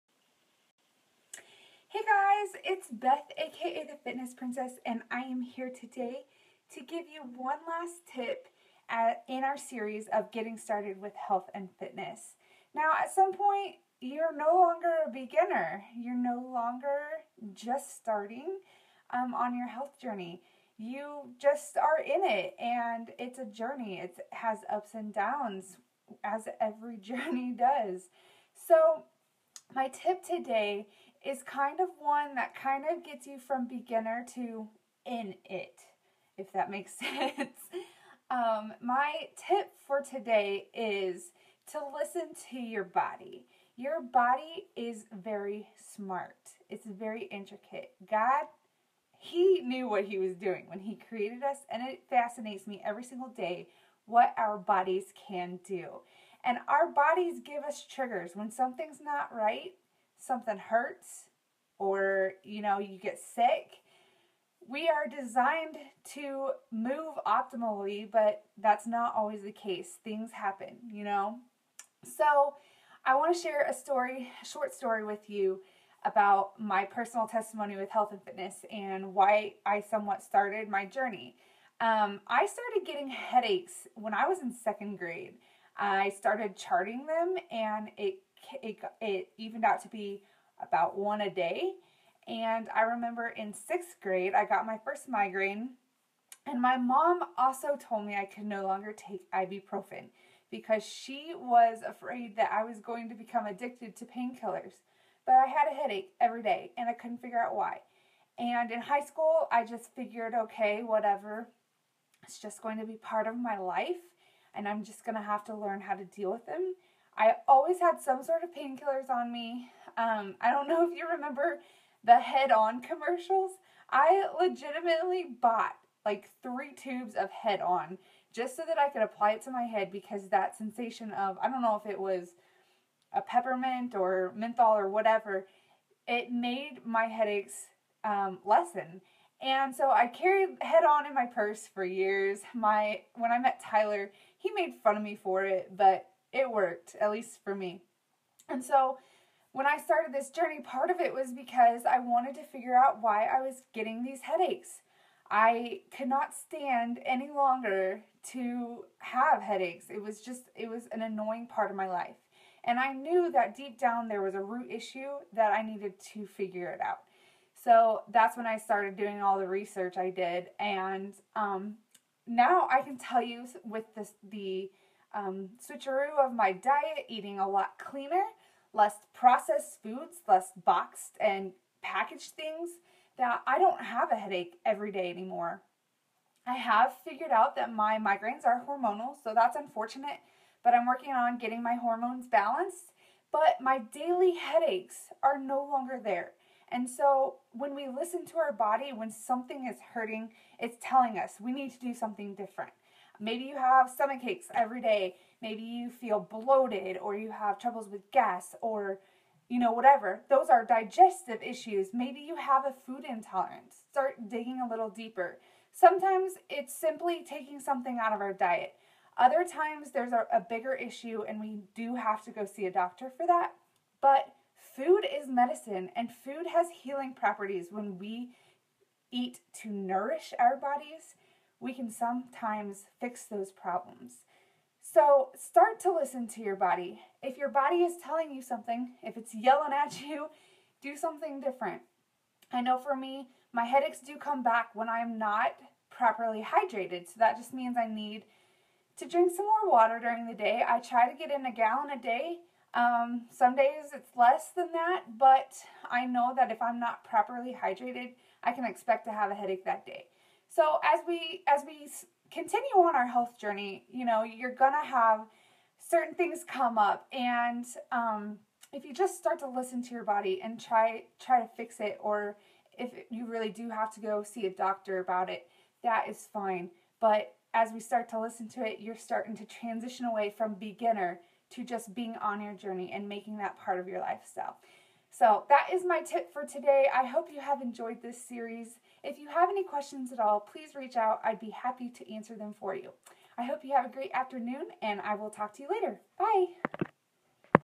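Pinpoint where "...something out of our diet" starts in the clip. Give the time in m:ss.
3:37.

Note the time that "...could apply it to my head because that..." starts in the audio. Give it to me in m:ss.
2:08.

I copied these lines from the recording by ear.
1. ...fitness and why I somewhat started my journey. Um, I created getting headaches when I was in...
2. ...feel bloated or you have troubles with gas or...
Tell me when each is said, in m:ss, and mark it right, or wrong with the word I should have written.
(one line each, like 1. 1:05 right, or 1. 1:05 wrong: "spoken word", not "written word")
1. 1:18 wrong: "started", not "created"
2. 3:25 right.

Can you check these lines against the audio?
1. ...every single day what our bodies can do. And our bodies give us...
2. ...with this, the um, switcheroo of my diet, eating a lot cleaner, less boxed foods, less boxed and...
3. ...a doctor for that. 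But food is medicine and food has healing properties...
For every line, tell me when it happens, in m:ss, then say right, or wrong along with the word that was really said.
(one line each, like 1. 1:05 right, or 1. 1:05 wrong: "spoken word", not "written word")
1. 0:52 right
2. 2:53 wrong: "processed", not "boxed"
3. 3:42 right.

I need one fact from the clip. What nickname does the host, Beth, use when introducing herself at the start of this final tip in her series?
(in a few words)
The Fitness Princess.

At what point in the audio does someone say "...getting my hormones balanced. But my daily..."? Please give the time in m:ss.
3:11.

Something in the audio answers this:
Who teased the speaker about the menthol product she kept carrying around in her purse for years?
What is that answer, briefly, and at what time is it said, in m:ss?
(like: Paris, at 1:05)
Tyler, at 2:23.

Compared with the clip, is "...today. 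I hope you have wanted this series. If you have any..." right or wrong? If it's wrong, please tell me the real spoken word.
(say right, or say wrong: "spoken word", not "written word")
wrong: "enjoyed", not "wanted".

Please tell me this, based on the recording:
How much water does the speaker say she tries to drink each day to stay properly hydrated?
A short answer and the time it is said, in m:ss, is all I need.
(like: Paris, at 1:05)
a gallon, at 4:11.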